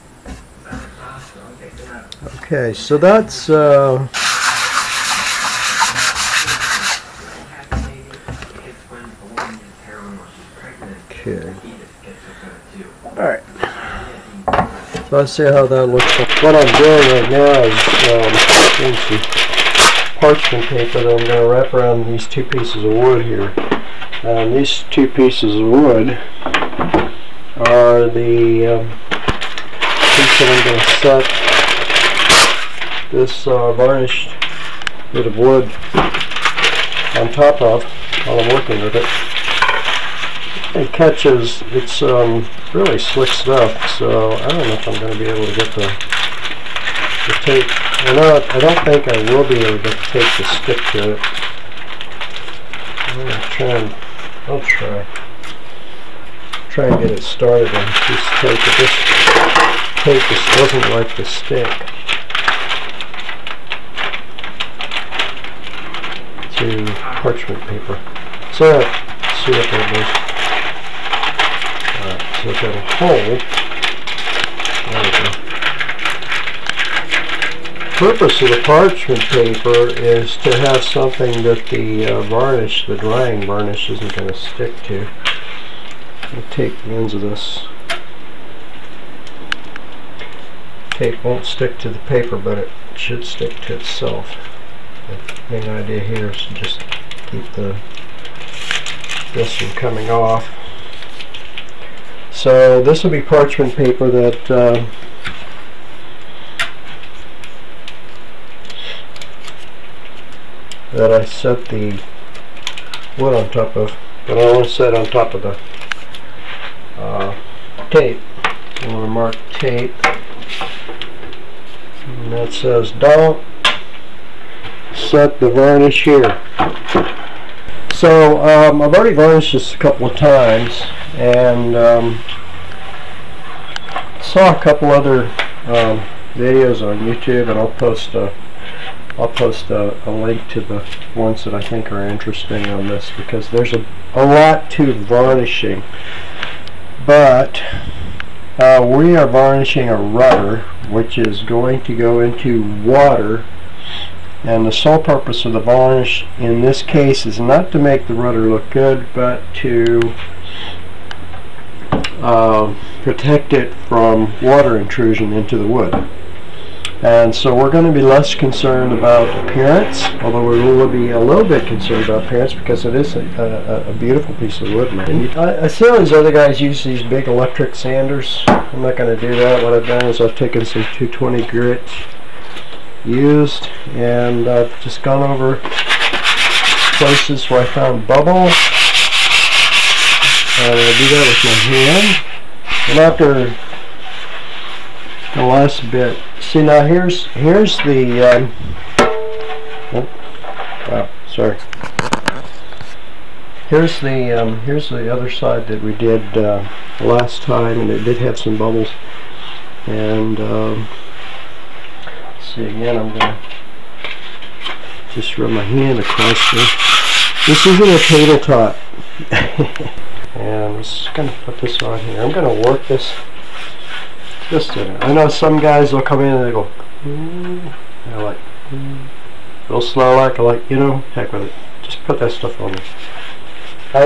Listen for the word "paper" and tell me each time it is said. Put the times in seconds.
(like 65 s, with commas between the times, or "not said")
20 s, 67 s, 79 s, 91 s, 103 s.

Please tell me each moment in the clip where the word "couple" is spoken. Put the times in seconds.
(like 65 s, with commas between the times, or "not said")
129 s, 134 s.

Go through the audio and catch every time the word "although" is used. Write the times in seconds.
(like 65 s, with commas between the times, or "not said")
170 s.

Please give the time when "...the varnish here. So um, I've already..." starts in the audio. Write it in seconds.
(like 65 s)
125 s.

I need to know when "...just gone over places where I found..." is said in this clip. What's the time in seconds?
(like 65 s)
184 s.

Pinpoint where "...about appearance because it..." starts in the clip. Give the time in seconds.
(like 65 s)
172 s.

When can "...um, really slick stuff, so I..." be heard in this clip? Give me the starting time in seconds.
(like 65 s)
42 s.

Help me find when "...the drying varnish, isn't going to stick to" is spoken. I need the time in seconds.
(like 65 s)
82 s.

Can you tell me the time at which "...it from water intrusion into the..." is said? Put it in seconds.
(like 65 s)
163 s.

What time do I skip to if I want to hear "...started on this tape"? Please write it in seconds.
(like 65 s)
57 s.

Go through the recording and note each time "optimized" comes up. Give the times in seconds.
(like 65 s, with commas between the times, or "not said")
not said.